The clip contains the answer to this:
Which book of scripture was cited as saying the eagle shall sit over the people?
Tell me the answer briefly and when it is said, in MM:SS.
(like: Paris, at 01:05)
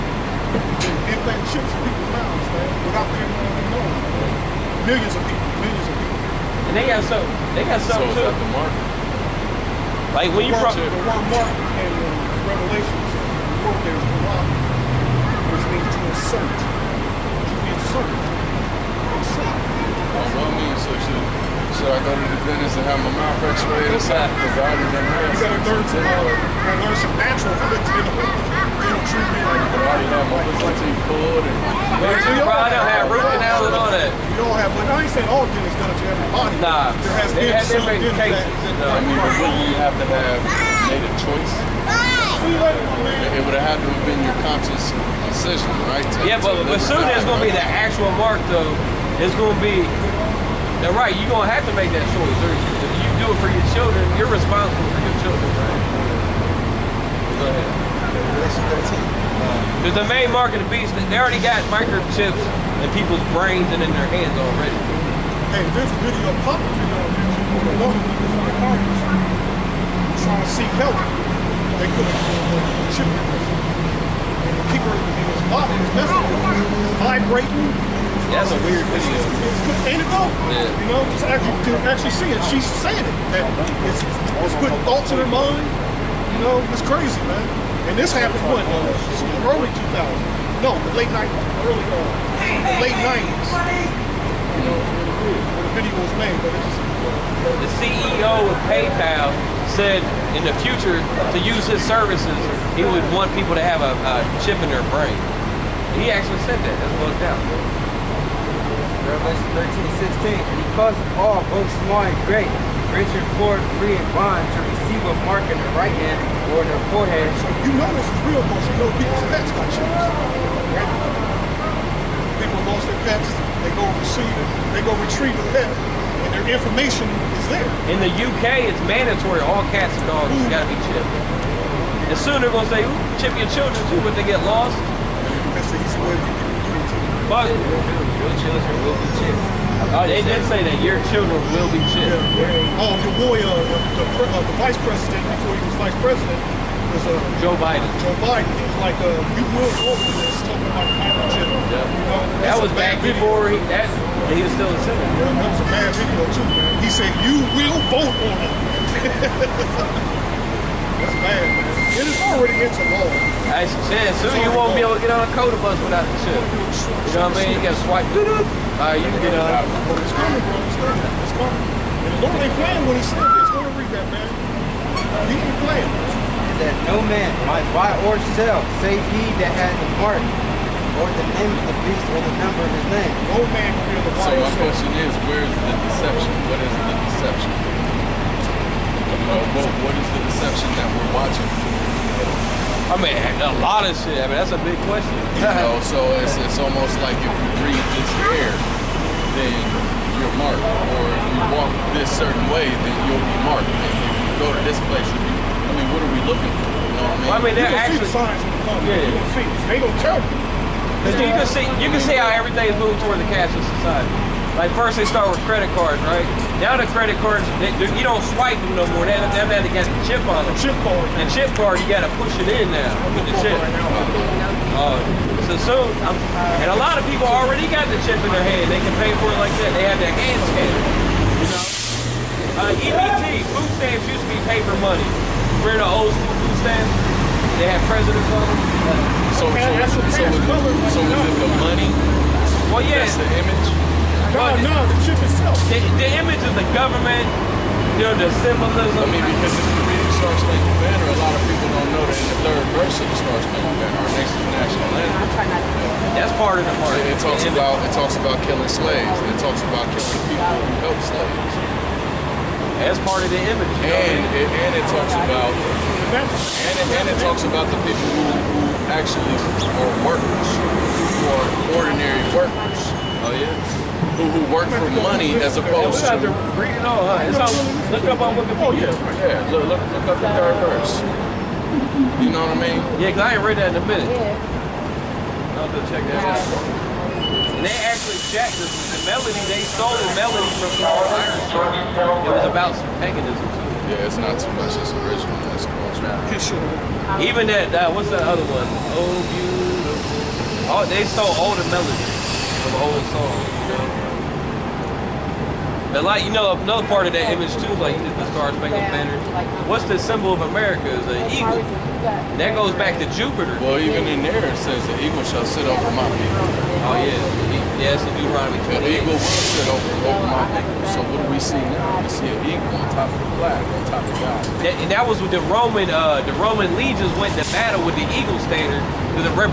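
Deuteronomy, at 05:18.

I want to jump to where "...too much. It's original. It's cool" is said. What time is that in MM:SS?
04:54.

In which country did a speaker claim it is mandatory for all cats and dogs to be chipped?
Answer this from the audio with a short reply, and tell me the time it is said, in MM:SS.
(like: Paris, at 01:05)
UK, at 02:08.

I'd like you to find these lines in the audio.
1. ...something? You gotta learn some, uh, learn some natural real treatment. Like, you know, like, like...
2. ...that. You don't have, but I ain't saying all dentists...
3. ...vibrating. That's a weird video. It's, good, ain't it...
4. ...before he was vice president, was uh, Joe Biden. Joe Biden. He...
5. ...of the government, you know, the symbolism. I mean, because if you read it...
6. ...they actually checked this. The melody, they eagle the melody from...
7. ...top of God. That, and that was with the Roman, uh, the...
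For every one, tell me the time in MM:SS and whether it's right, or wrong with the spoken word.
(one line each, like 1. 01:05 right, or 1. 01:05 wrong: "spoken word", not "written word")
1. 00:24 right
2. 00:33 right
3. 01:17 right
4. 02:25 right
5. 04:06 right
6. 04:47 wrong: "stole", not "eagle"
7. 05:23 right.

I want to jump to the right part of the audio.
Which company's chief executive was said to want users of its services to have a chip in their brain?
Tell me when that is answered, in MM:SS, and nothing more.
01:38.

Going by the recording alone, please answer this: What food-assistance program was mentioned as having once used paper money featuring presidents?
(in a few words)
EBT.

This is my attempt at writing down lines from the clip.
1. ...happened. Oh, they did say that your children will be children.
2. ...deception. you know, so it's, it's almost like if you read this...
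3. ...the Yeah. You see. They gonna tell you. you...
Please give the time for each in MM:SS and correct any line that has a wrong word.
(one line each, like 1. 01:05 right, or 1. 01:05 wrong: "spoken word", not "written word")
1. 02:19 wrong: "chipped", not "happened"
2. 03:14 wrong: "question", not "deception"
3. 03:28 right.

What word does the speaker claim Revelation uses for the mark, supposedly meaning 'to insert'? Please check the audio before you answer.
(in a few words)
Quran.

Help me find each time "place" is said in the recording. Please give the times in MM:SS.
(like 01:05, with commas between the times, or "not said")
03:24.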